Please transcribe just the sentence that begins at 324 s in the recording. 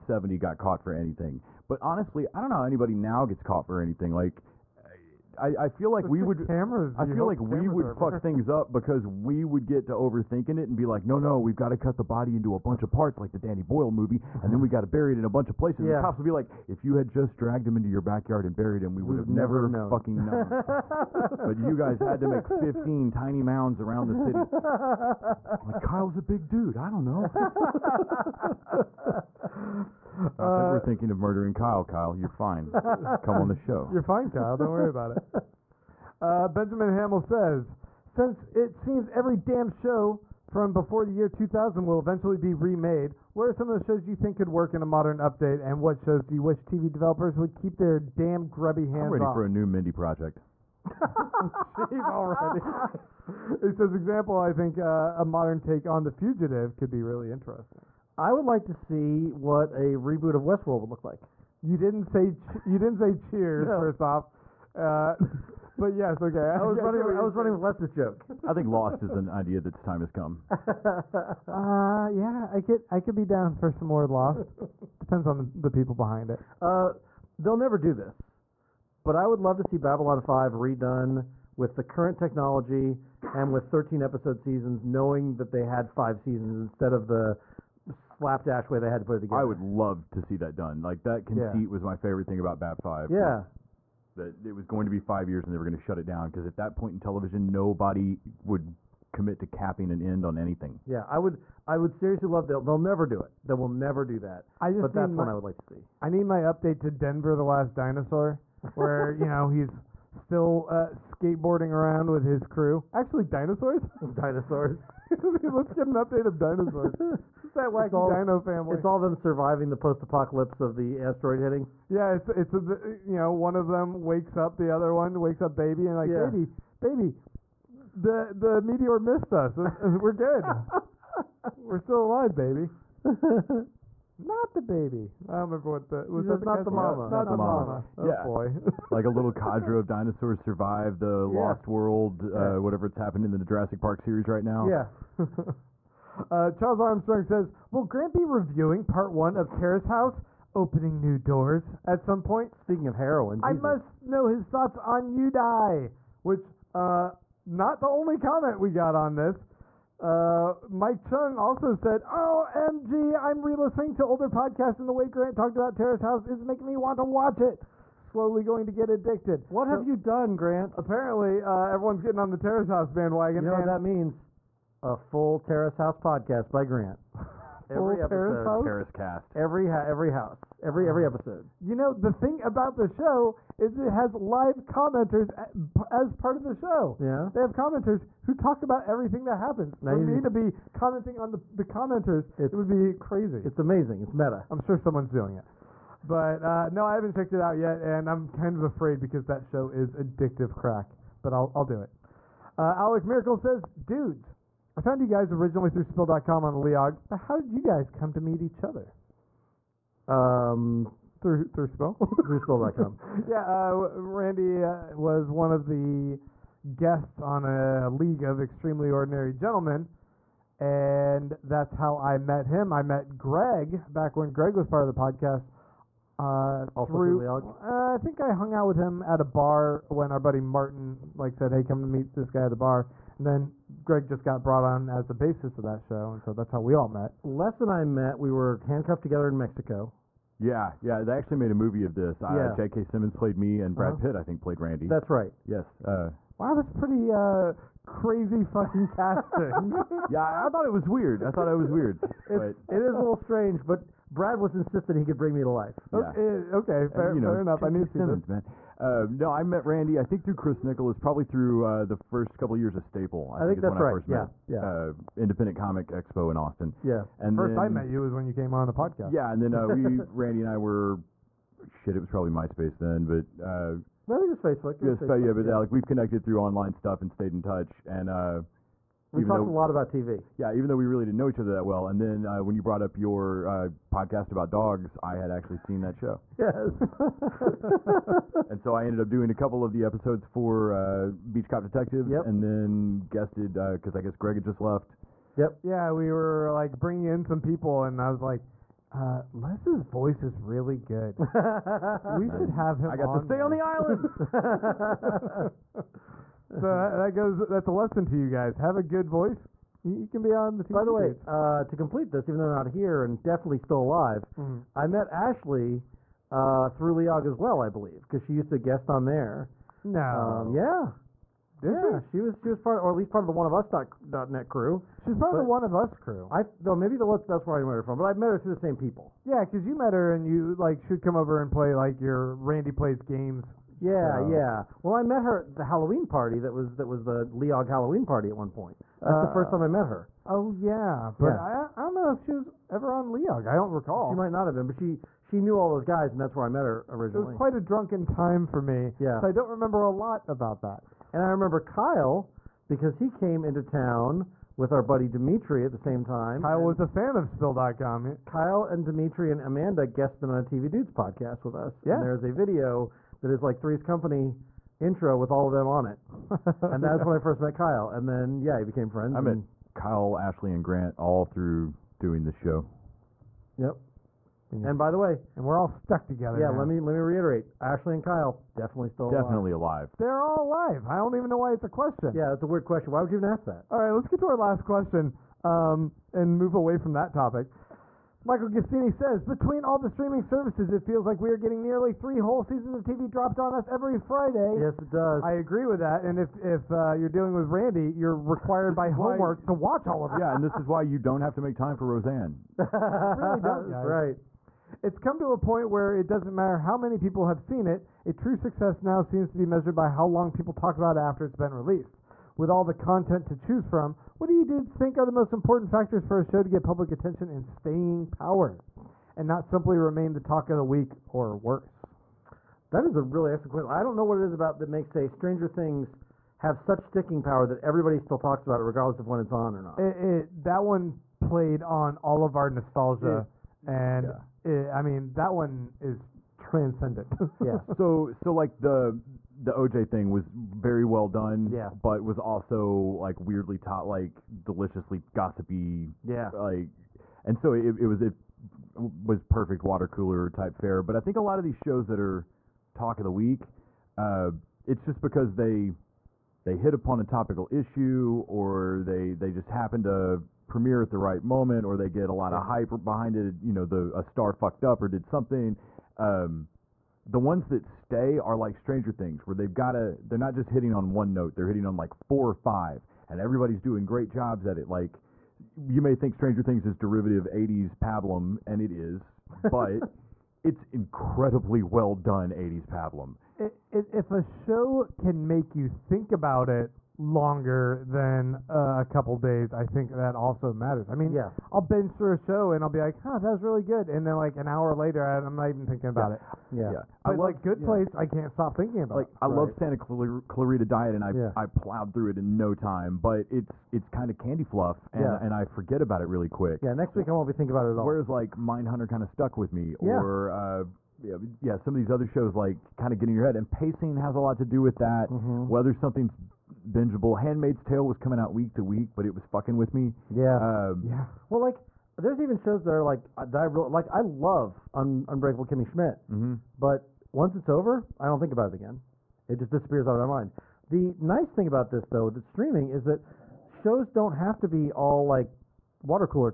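She's part but of the One of Us crew.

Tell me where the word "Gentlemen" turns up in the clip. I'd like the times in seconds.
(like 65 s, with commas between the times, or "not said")
219 s.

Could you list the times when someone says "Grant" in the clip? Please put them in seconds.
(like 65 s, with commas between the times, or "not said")
147 s, 165 s, 170 s, 176 s, 370 s.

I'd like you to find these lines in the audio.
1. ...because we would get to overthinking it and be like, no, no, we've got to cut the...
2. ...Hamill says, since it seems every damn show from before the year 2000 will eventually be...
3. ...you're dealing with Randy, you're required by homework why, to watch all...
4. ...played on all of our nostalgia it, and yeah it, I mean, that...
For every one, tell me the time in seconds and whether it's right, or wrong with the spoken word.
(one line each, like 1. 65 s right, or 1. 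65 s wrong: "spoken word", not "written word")
1. 8 s right
2. 36 s right
3. 396 s right
4. 431 s right.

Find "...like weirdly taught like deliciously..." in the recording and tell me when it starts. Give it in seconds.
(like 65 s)
442 s.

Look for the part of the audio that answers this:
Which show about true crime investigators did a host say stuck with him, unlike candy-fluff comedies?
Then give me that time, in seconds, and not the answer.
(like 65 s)
508 s.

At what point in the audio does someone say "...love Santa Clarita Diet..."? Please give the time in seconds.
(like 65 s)
499 s.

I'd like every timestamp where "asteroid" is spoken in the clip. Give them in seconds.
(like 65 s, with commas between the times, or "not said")
121 s.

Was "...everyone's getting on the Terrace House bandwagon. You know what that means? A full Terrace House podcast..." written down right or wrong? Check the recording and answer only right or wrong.
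right.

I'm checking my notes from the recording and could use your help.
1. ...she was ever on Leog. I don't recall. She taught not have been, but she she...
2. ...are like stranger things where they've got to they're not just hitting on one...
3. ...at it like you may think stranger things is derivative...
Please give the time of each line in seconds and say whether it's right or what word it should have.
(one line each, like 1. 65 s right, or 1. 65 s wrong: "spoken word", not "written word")
1. 342 s wrong: "might", not "taught"
2. 468 s right
3. 474 s right.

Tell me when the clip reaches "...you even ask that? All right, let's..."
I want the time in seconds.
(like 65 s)
383 s.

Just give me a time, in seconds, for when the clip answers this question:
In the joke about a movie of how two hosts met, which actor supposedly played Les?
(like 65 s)
242 s.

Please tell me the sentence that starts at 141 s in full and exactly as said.
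Lost World, uh, it's happened in the Jurassic Park series right now.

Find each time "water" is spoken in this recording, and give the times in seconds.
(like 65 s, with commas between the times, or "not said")
449 s, 535 s.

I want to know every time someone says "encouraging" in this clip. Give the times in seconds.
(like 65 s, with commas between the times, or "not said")
not said.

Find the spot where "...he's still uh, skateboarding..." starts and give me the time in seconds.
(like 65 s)
109 s.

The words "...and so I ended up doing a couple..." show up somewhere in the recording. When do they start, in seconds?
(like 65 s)
288 s.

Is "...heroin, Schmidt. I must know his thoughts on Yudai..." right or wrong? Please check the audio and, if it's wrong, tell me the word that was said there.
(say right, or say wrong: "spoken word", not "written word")
wrong: "Jesus", not "Schmidt".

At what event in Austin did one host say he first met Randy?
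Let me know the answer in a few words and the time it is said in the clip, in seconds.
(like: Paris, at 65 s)
Independent Comic Expo, at 265 s.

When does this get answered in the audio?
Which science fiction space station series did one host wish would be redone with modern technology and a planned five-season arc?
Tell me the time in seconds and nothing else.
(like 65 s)
79 s.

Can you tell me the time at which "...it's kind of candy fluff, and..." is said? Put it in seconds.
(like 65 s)
503 s.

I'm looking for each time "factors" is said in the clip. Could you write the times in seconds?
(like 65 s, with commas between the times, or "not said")
415 s.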